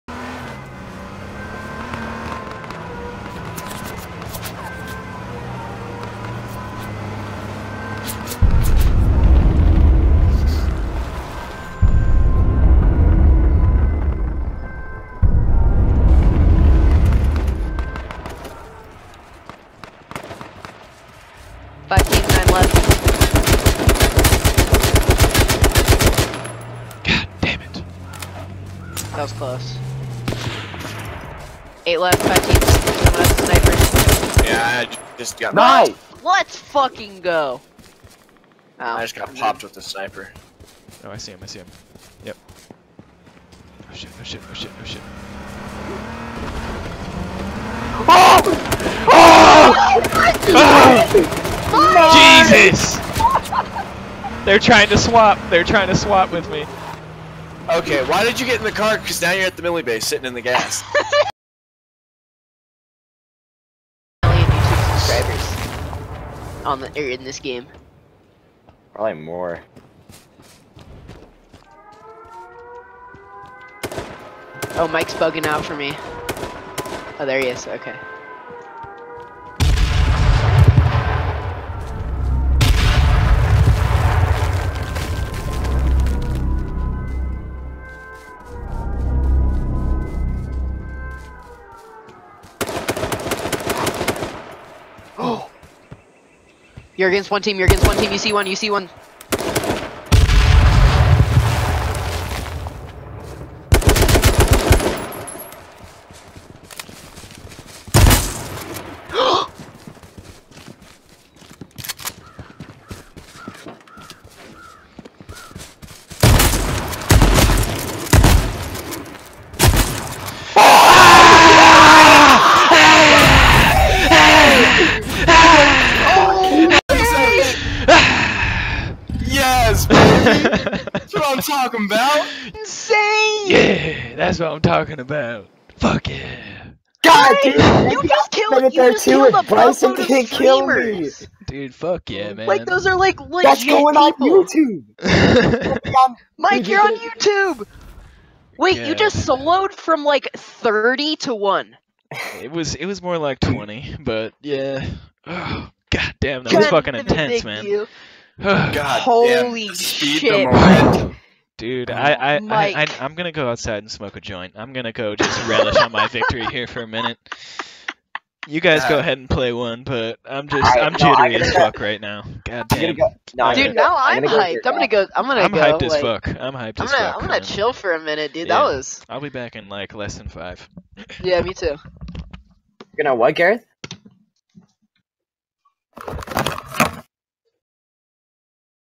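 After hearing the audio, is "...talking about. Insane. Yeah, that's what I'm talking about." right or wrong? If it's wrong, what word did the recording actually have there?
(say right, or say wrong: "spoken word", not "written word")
right.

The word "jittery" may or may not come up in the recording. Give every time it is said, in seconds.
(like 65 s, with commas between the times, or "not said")
170 s.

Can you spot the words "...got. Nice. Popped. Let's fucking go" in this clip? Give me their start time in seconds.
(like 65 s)
35 s.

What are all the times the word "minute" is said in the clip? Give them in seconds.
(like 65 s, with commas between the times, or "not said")
166 s, 177 s.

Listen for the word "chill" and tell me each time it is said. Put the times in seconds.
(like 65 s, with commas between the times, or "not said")
177 s.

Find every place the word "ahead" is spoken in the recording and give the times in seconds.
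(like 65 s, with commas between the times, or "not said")
168 s.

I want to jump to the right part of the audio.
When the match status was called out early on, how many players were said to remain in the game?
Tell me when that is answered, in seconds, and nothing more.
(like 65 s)
31 s.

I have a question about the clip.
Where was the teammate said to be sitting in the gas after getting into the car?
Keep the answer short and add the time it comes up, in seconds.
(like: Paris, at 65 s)
Millie base, at 59 s.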